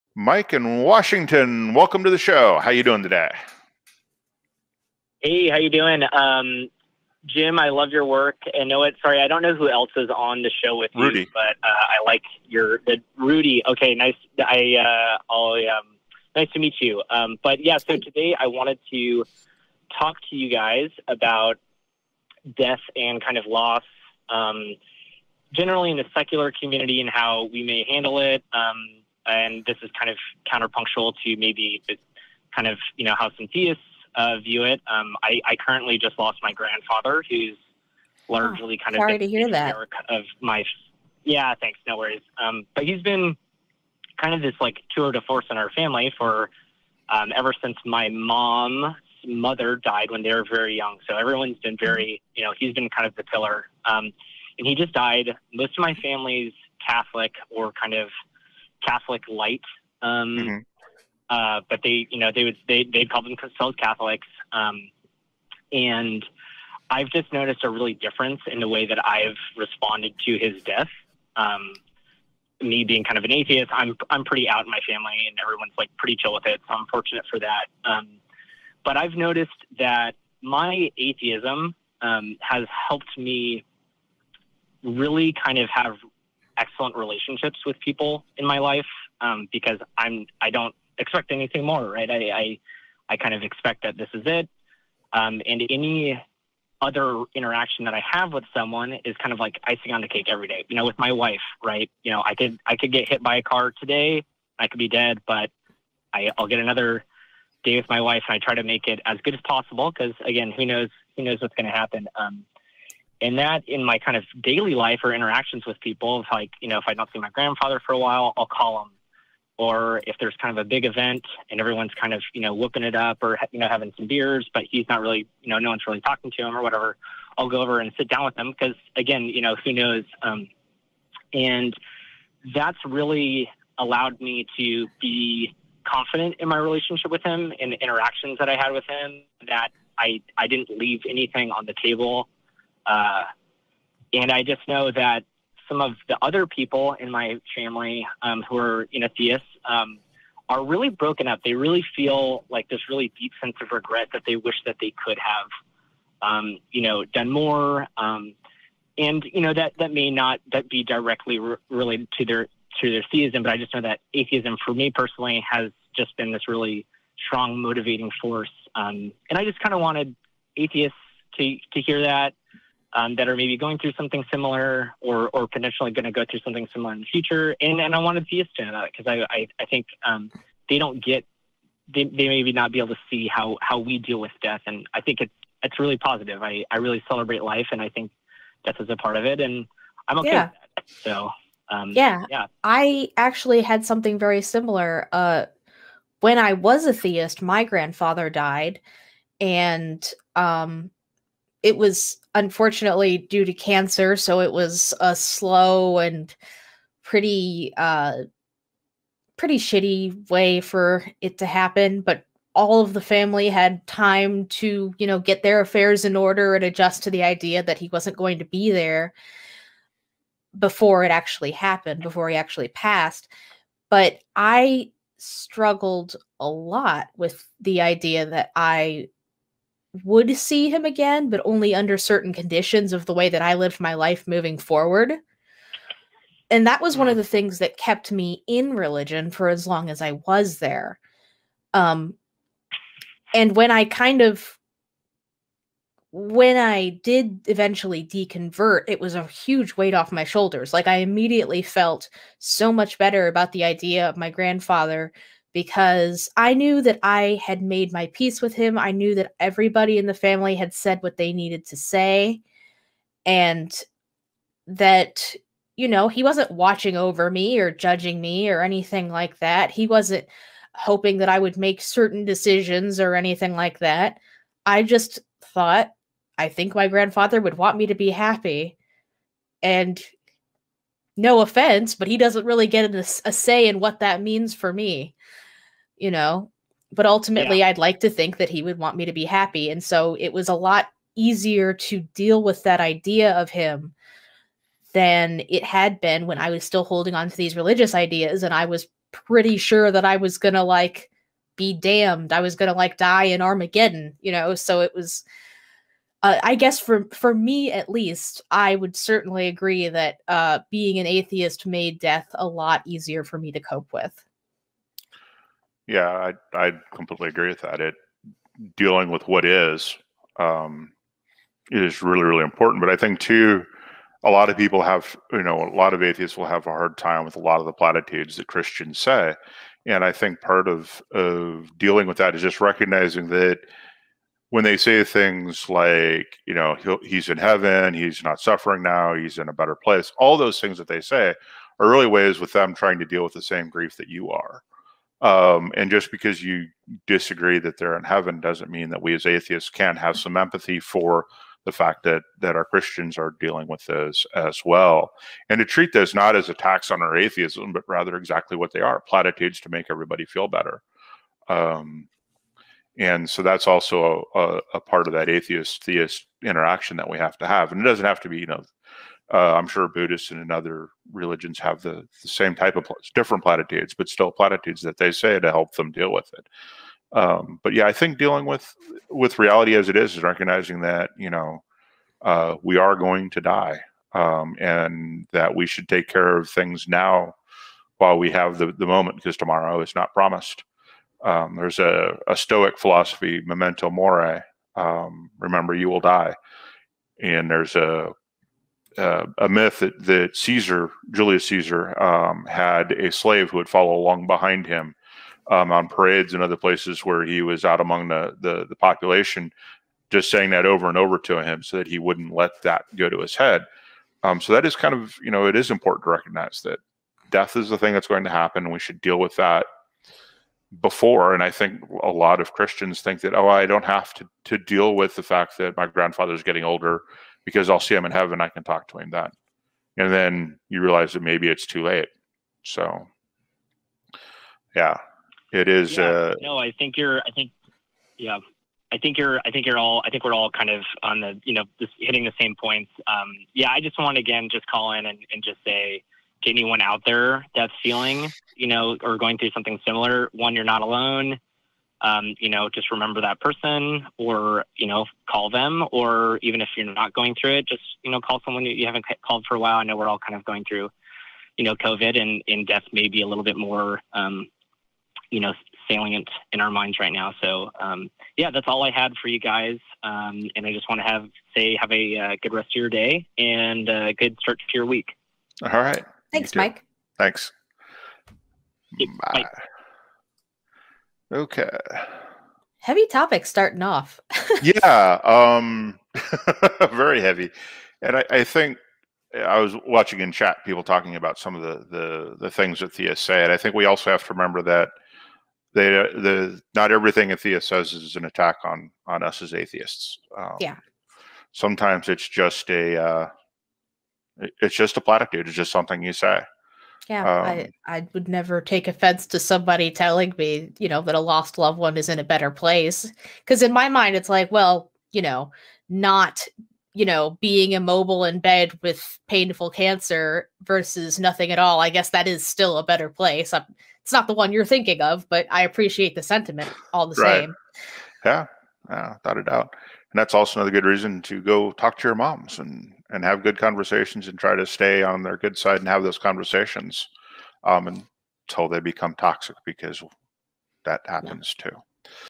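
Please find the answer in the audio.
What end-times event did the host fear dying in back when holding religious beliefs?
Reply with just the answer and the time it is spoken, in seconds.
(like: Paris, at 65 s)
Armageddon, at 303 s.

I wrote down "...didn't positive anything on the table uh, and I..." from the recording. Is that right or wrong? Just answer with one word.
wrong.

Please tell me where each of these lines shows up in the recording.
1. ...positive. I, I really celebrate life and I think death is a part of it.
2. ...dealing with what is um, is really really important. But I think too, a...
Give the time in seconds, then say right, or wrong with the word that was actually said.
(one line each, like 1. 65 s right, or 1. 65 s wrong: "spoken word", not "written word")
1. 185 s right
2. 318 s right.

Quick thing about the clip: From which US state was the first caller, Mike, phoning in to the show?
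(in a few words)
Washington.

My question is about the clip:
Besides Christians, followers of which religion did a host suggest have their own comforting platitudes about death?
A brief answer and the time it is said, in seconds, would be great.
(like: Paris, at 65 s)
Buddhists, at 369 s.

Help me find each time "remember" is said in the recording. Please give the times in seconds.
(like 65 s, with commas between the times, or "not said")
395 s, 452 s, 494 s.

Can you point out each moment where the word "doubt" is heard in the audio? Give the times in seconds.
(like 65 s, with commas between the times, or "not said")
529 s.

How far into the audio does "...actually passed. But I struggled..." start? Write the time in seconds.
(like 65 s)
222 s.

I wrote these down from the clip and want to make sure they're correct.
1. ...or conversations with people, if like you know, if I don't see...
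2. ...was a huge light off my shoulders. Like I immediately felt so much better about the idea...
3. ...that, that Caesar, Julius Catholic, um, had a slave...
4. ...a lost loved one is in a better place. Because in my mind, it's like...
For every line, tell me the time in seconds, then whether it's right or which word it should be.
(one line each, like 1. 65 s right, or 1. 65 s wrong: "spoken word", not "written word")
1. 115 s wrong: "interactions", not "conversations"
2. 248 s wrong: "weight", not "light"
3. 399 s wrong: "Caesar", not "Catholic"
4. 511 s right.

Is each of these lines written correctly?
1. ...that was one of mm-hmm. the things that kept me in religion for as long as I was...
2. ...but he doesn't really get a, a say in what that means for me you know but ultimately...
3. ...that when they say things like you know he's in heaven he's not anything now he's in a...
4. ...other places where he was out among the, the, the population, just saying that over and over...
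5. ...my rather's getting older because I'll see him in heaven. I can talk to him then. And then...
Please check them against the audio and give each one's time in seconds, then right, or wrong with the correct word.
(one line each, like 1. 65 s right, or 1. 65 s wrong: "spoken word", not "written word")
1. 236 s right
2. 281 s right
3. 333 s wrong: "suffering", not "anything"
4. 406 s right
5. 425 s wrong: "grandfather", not "rather".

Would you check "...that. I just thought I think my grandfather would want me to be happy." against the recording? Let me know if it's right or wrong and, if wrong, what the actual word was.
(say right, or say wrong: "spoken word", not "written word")
right.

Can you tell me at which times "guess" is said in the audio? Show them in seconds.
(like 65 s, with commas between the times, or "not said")
306 s, 521 s.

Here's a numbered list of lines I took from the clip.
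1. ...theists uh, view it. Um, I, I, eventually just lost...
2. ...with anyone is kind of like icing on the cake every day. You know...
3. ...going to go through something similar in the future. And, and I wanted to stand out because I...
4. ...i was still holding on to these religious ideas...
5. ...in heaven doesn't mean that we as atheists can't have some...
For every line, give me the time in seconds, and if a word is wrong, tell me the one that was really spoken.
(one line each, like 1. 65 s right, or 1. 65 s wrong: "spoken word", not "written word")
1. 33 s wrong: "currently", not "eventually"
2. 98 s wrong: "someone", not "anyone"
3. 175 s right
4. 296 s right
5. 347 s right.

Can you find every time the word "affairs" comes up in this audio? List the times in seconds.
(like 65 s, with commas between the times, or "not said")
215 s.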